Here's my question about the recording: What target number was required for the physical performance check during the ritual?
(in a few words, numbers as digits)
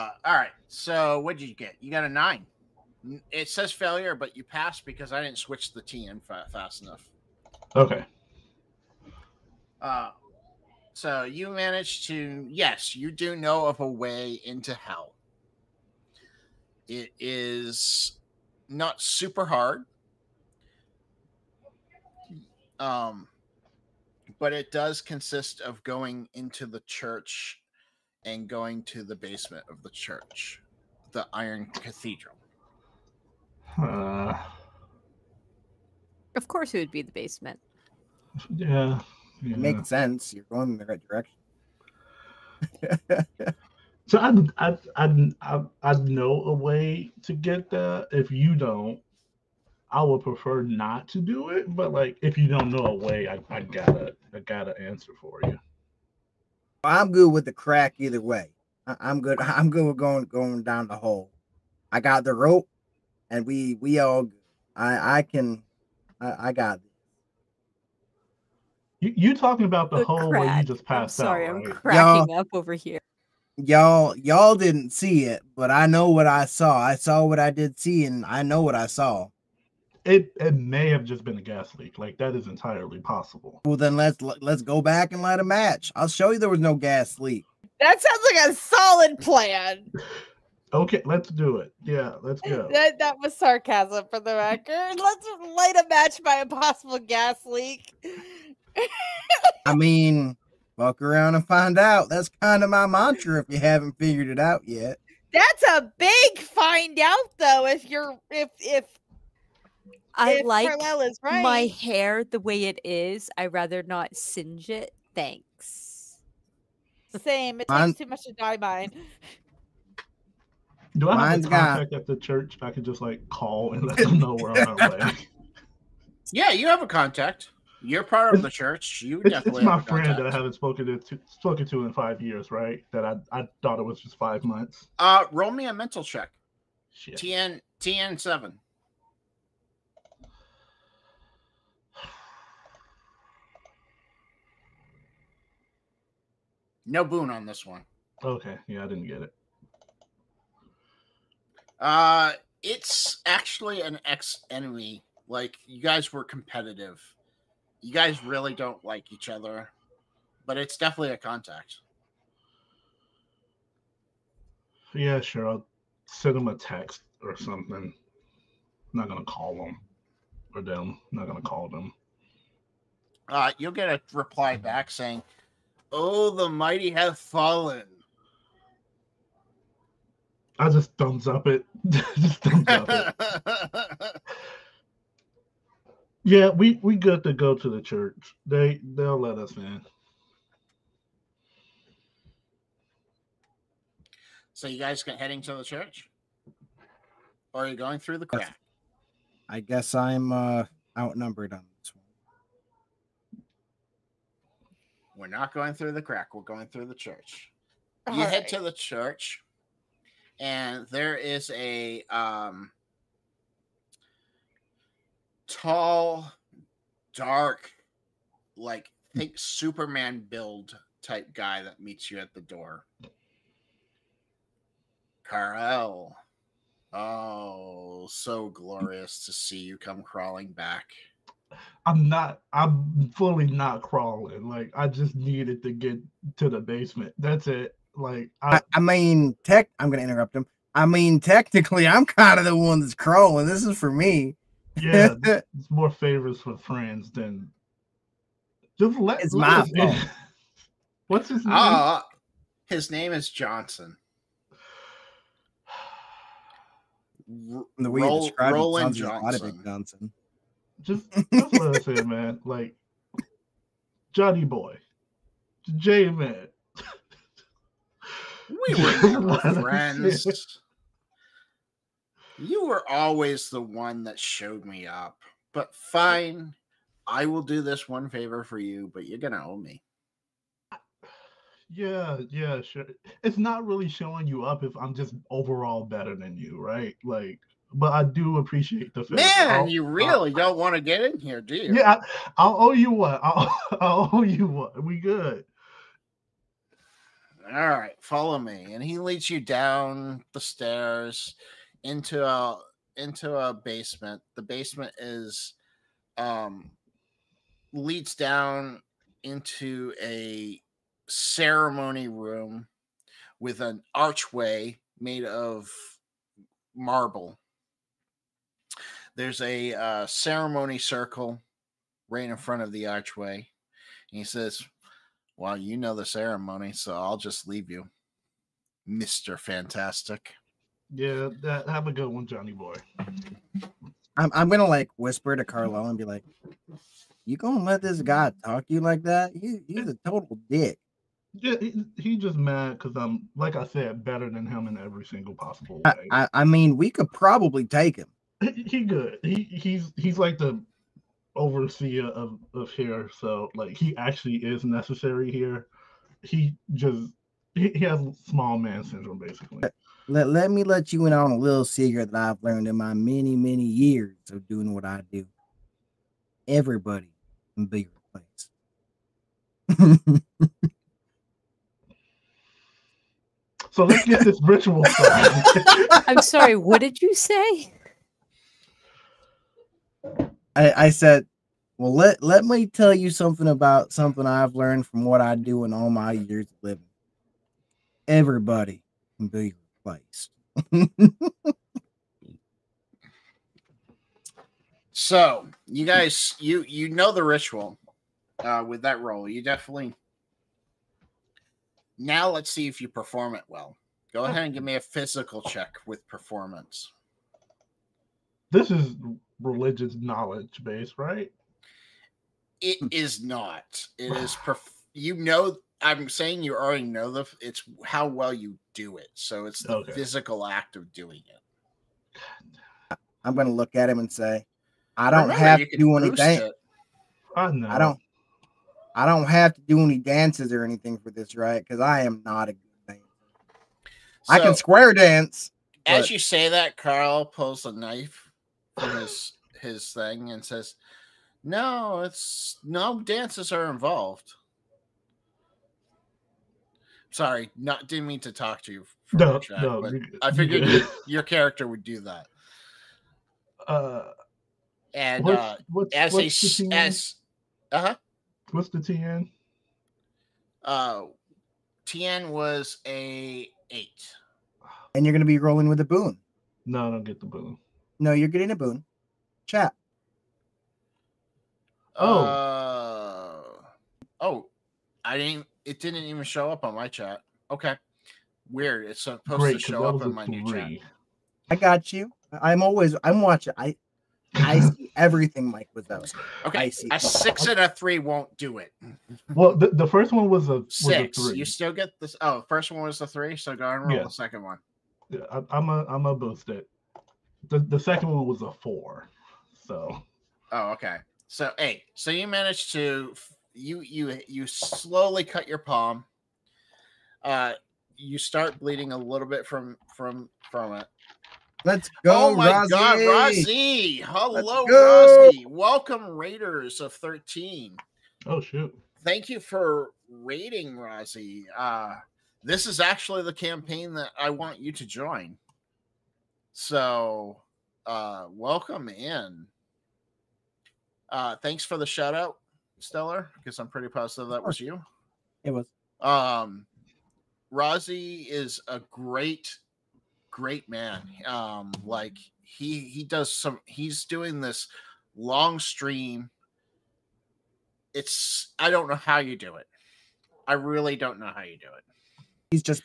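8.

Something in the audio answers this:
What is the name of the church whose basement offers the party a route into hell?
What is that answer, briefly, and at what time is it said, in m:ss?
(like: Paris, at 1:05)
Iron Cathedral, at 0:31.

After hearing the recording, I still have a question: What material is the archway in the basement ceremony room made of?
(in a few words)
marble.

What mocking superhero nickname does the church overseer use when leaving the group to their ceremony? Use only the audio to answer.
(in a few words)
Mr. Fantastic.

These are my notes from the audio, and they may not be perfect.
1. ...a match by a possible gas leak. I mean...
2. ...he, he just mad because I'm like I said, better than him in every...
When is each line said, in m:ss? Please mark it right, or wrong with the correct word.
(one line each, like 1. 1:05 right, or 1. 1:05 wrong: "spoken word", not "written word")
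1. 1:35 right
2. 5:41 right.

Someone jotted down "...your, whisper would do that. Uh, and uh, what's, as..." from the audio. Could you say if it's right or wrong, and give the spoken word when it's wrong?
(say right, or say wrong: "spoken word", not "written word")
wrong: "character", not "whisper".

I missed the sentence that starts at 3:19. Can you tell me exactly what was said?
I guess I'm uh, outnumbered on this one.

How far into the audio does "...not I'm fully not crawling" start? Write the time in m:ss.
3:52.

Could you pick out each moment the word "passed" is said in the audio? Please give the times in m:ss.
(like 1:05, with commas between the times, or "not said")
0:04, 1:10.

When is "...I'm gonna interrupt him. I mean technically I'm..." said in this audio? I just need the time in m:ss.
3:59.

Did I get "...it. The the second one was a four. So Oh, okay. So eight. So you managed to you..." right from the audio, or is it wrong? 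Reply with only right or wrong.
right.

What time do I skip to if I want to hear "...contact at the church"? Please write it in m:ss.
2:01.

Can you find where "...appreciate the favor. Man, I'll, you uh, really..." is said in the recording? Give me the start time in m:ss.
4:48.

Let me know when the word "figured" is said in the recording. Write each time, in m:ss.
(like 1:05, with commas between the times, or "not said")
1:43, 7:30.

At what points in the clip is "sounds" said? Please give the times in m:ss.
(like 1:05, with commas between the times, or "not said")
1:28, 4:18.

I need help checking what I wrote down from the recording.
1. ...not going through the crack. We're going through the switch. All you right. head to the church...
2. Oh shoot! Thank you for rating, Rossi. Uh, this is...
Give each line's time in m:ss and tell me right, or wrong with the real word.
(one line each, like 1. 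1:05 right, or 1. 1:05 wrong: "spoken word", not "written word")
1. 3:25 wrong: "church", not "switch"
2. 8:38 right.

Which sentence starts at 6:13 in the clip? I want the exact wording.
so let's get this ritual started.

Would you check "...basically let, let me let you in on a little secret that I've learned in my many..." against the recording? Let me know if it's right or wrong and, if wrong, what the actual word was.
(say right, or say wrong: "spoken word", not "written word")
right.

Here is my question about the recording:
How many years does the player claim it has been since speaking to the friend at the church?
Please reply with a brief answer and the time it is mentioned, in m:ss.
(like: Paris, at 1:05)
5, at 2:11.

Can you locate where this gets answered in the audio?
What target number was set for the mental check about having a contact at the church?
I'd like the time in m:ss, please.
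2:17.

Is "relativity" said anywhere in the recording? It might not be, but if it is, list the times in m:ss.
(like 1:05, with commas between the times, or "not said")
not said.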